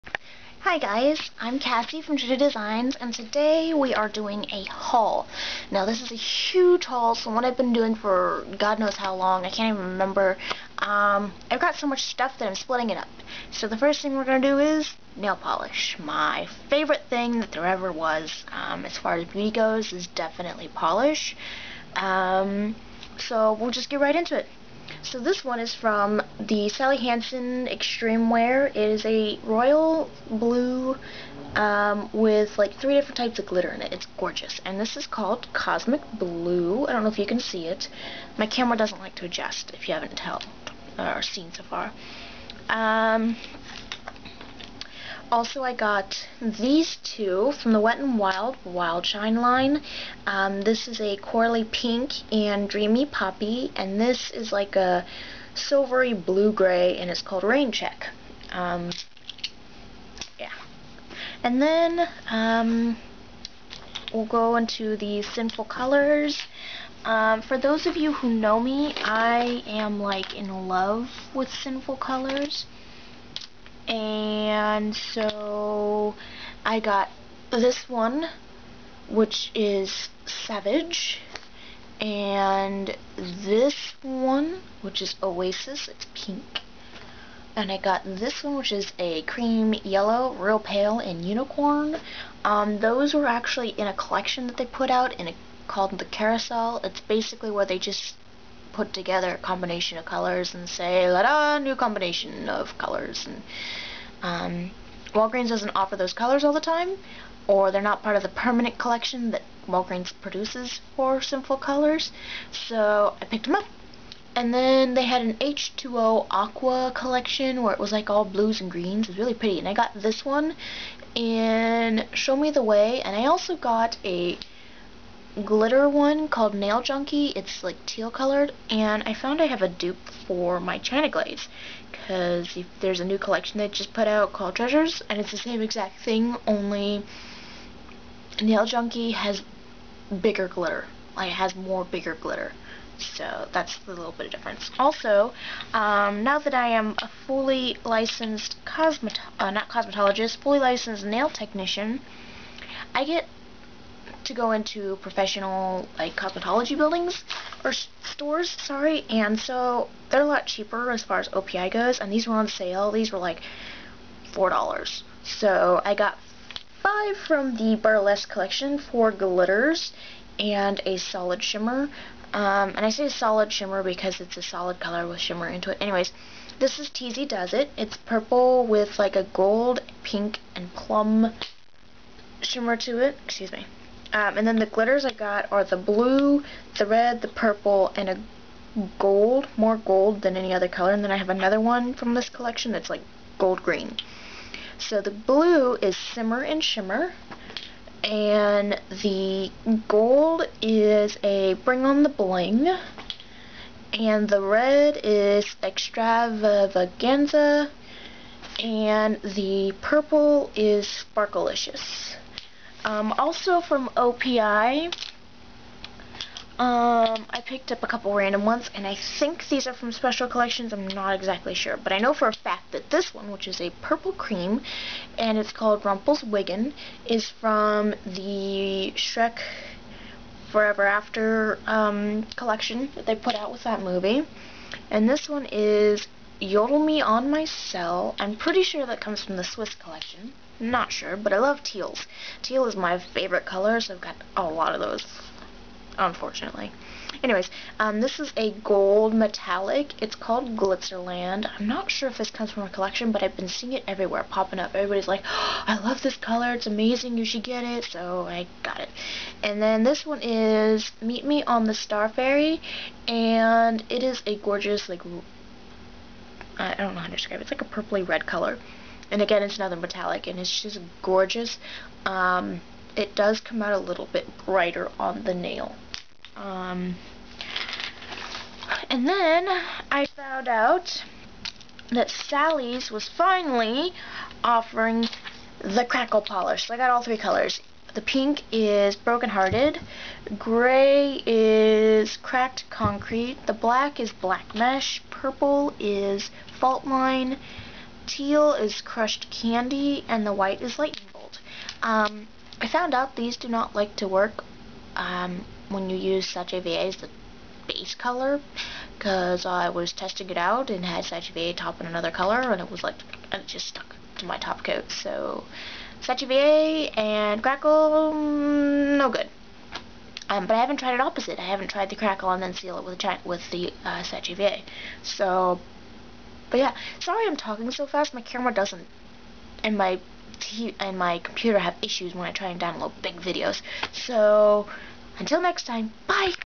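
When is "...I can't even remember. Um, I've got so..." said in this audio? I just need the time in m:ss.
0:09.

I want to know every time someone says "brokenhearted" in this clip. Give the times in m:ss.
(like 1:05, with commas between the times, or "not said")
4:48.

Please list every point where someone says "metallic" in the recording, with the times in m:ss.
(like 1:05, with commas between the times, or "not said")
4:09, 4:29.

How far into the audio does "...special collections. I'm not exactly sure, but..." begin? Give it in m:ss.
3:39.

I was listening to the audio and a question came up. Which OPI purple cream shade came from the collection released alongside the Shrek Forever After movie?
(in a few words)
Wiggin.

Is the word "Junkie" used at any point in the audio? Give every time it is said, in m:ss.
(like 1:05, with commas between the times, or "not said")
2:06, 2:18.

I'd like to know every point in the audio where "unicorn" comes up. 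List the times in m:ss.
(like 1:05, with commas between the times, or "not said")
1:31.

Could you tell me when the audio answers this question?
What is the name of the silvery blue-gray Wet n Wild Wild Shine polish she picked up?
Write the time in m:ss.
0:57.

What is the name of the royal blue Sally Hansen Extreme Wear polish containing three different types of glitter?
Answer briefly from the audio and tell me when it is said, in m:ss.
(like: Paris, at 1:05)
Cosmic Blue, at 0:35.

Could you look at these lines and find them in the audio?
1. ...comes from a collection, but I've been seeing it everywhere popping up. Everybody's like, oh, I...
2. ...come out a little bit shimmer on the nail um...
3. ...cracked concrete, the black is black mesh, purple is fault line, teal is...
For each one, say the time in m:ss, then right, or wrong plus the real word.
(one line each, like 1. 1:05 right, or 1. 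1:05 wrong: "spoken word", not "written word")
1. 4:12 right
2. 4:33 wrong: "brighter", not "shimmer"
3. 4:52 right.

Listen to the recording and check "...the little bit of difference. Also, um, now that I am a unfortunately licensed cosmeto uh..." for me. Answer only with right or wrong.
wrong.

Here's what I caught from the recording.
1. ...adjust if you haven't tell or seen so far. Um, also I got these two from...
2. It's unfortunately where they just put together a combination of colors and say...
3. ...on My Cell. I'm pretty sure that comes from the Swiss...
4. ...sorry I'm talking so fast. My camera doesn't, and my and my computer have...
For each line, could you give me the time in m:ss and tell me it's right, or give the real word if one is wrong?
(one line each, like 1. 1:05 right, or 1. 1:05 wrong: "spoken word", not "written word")
1. 0:39 right
2. 1:36 wrong: "basically", not "unfortunately"
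3. 3:57 right
4. 5:26 right.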